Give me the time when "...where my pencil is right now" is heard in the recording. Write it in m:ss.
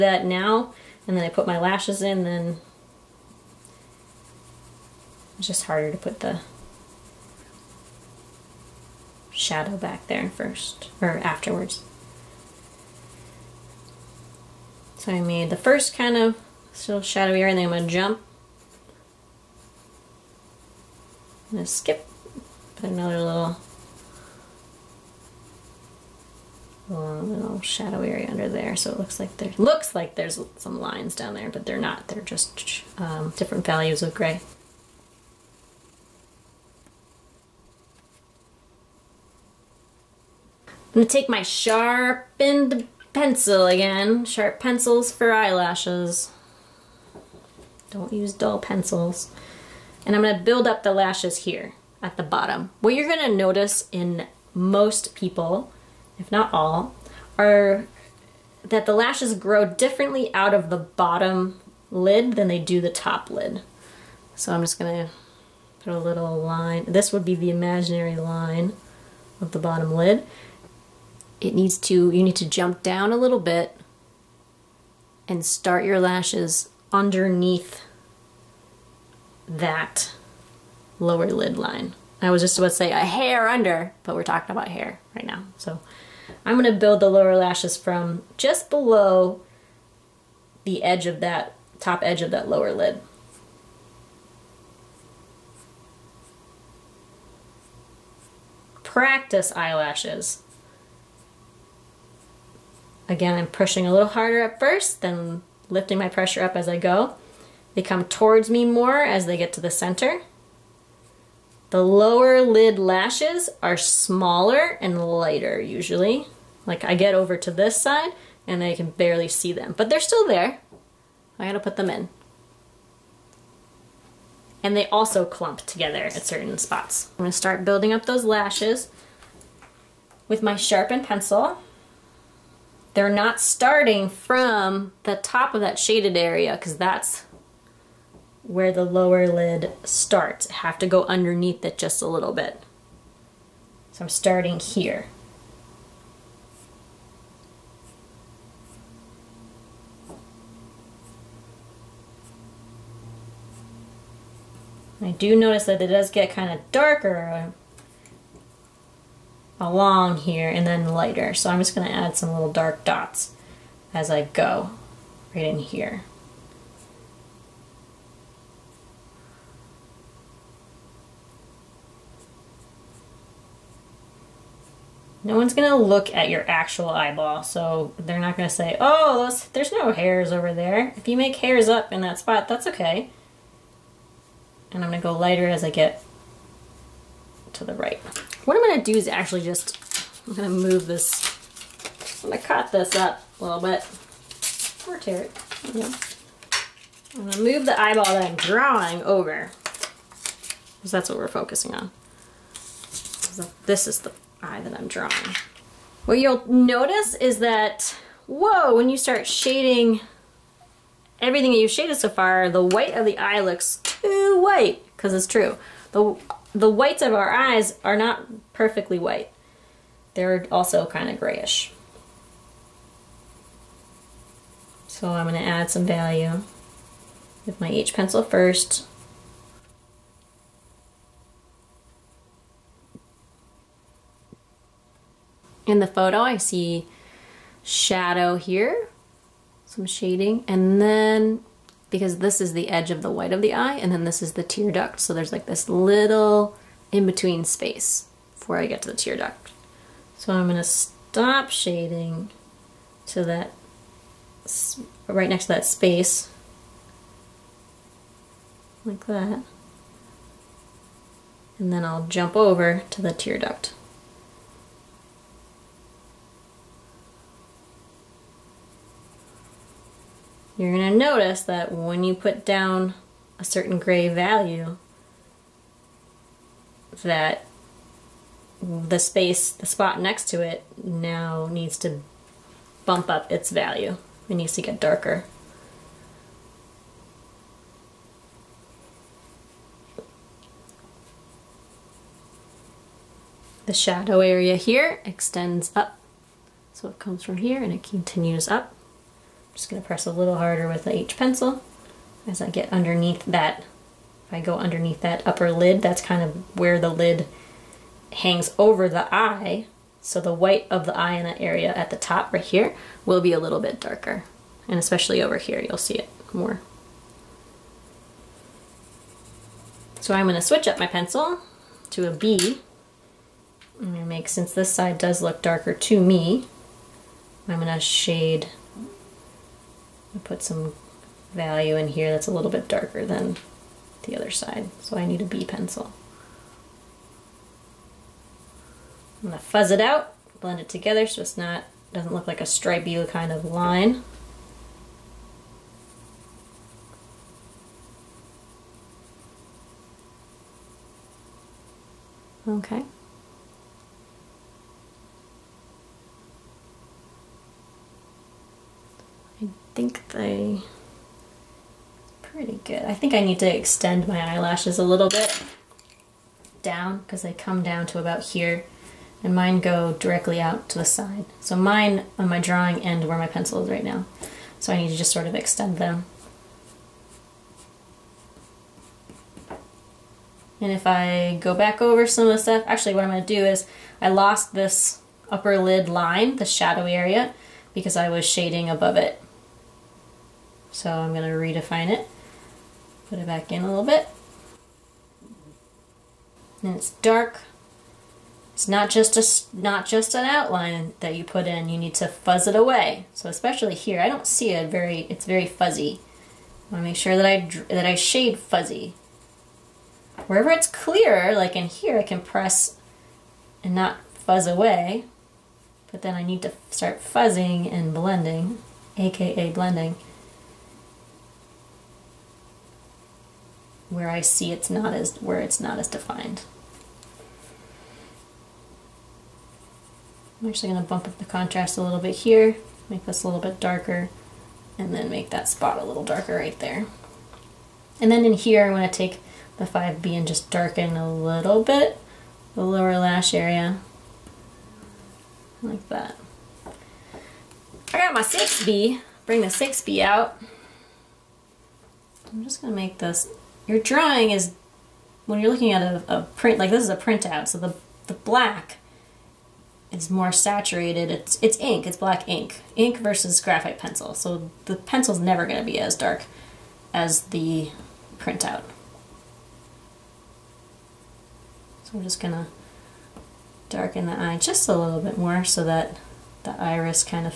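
6:13.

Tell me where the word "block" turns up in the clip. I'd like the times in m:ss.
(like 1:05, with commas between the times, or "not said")
not said.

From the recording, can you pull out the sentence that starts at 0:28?
So it looks like there looks like there's some lines down there, but they're not.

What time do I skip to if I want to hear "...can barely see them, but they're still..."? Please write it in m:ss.
1:58.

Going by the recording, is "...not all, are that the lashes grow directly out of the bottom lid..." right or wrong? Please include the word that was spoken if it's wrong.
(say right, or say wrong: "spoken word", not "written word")
wrong: "differently", not "directly".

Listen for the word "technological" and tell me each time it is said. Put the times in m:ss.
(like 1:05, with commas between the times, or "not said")
not said.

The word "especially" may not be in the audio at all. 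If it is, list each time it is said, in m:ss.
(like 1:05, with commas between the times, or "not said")
5:14, 6:43.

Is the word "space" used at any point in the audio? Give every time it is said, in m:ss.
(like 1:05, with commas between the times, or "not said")
4:07, 4:15, 4:38.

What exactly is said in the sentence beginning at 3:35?
The the whites of our eyes are not perfectly white.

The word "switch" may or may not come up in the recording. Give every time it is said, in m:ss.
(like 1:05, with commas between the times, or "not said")
5:20.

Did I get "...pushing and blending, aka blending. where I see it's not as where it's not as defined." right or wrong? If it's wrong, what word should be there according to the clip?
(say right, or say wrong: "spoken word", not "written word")
wrong: "fuzzing", not "pushing".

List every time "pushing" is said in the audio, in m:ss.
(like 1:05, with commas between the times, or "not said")
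1:43.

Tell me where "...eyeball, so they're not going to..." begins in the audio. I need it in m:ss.
2:56.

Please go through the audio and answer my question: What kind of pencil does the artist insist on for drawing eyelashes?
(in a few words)
Sharp pencils.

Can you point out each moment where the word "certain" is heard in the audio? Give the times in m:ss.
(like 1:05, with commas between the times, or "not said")
2:06, 4:33.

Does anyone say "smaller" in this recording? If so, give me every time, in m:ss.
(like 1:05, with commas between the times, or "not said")
1:53.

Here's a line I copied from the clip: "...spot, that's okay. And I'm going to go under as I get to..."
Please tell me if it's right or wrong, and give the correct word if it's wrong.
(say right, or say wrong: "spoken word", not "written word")
wrong: "lighter", not "under".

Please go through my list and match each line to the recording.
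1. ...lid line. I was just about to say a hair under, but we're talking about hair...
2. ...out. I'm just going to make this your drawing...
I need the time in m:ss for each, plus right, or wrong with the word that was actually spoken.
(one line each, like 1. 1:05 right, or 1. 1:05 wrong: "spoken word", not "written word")
1. 1:21 right
2. 7:30 right.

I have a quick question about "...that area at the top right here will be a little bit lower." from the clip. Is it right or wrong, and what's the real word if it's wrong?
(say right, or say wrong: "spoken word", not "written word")
wrong: "darker", not "lower".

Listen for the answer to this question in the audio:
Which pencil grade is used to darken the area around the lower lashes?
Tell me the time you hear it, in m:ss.
7:19.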